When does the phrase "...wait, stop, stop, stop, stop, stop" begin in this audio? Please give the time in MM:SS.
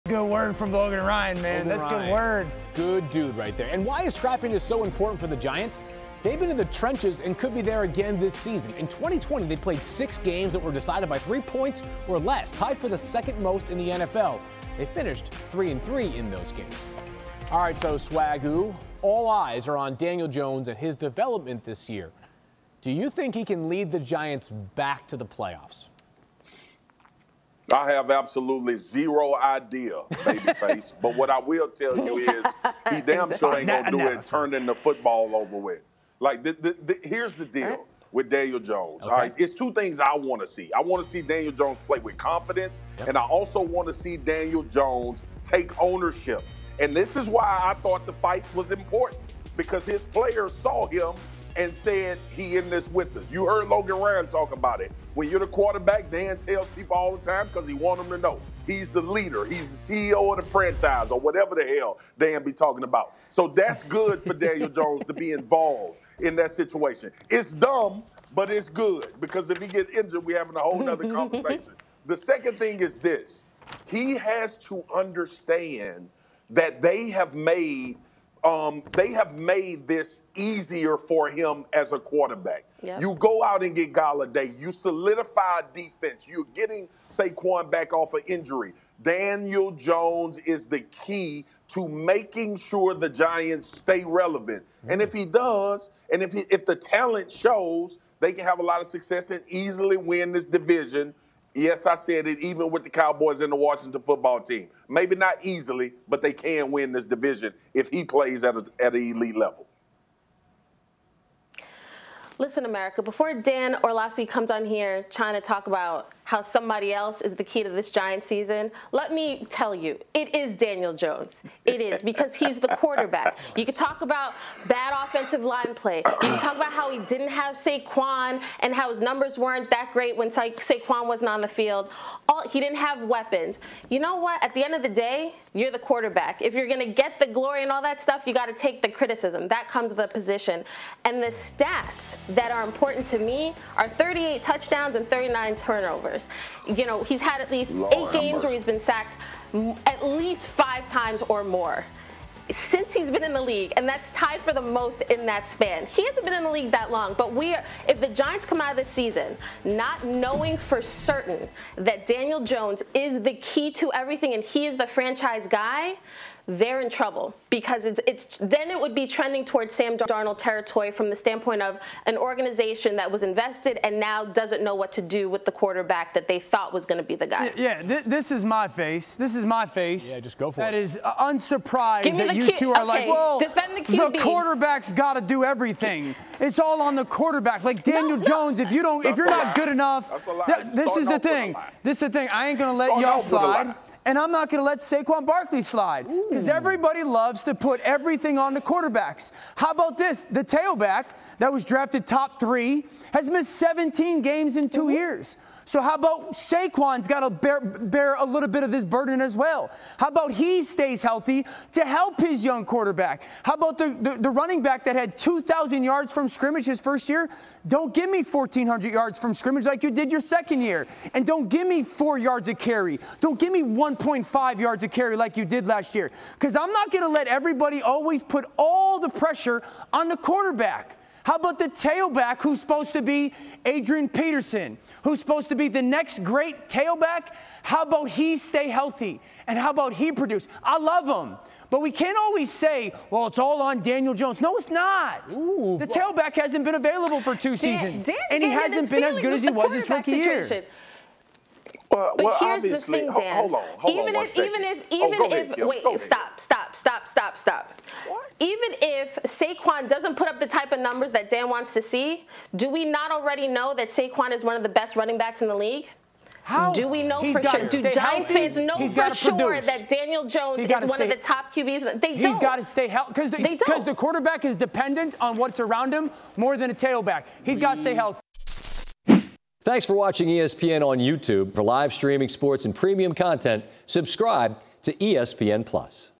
04:15.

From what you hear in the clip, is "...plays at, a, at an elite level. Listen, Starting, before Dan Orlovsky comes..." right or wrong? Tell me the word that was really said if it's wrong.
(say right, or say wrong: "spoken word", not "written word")
wrong: "America", not "Starting".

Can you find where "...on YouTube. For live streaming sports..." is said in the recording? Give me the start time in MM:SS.
04:40.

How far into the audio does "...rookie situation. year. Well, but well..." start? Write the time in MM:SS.
04:09.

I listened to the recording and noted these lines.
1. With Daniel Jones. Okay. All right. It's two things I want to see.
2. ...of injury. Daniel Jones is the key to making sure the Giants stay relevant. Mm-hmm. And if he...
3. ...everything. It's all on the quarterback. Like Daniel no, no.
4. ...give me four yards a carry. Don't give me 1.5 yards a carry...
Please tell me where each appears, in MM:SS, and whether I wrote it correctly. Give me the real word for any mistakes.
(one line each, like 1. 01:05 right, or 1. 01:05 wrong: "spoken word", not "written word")
1. 00:38 right
2. 01:28 right
3. 03:05 right
4. 03:41 right.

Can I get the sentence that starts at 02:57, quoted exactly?
Yeah, th- this is my face.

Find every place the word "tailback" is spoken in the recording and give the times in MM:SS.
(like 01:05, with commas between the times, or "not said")
03:20, 03:51, 03:56, 04:05, 04:36.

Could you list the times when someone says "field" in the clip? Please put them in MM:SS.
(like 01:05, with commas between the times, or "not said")
02:11.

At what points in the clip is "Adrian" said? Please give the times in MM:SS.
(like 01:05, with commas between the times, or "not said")
03:53.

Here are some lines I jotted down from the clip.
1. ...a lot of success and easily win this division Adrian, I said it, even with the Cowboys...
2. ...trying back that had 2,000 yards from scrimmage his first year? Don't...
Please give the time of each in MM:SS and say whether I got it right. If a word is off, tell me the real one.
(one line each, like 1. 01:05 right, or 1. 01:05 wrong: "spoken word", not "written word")
1. 01:38 wrong: "Yes", not "Adrian"
2. 03:34 wrong: "running", not "trying".